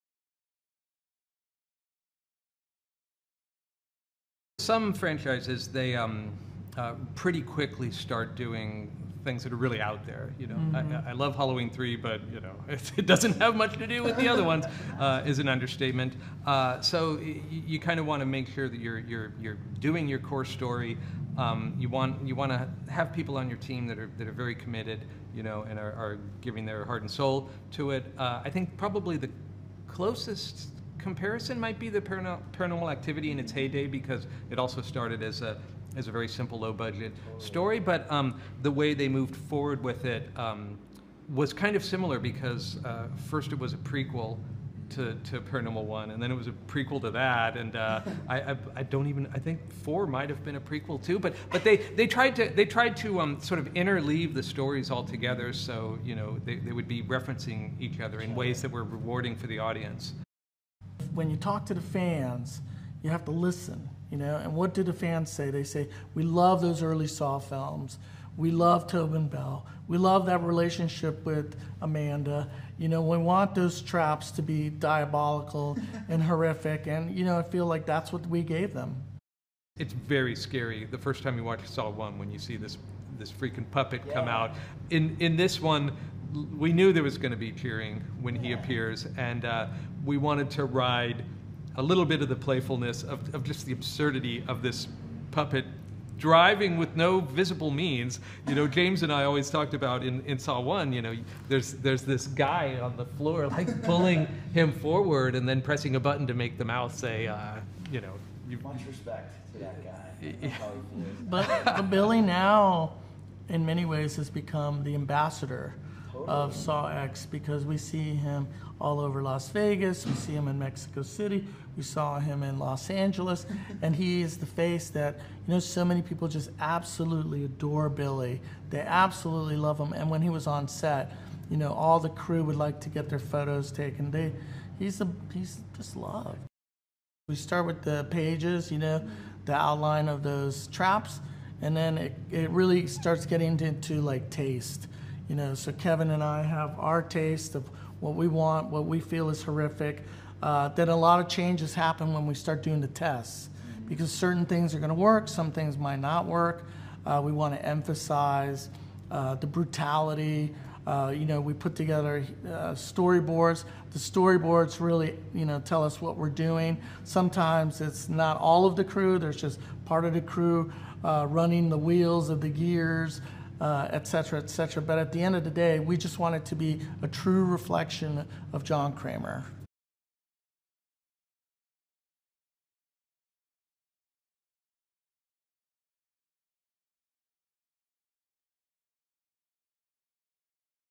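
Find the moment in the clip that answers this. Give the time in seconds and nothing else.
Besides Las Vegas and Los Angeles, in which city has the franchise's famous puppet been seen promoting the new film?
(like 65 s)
120 s.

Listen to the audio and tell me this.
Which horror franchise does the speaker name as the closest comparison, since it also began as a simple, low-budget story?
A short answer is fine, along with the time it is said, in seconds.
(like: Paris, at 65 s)
Paranormal Activity, at 32 s.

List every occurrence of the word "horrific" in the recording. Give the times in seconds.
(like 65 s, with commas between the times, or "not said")
76 s, 149 s.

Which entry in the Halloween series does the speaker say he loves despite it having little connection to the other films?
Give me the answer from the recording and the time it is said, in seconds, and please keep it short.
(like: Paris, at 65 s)
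Halloween 3, at 11 s.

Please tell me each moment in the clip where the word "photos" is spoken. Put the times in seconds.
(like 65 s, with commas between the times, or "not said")
133 s.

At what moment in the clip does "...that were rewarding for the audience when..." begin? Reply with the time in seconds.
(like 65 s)
58 s.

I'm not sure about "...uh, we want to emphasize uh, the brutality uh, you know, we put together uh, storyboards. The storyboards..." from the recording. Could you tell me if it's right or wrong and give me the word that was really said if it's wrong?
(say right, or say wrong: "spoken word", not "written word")
right.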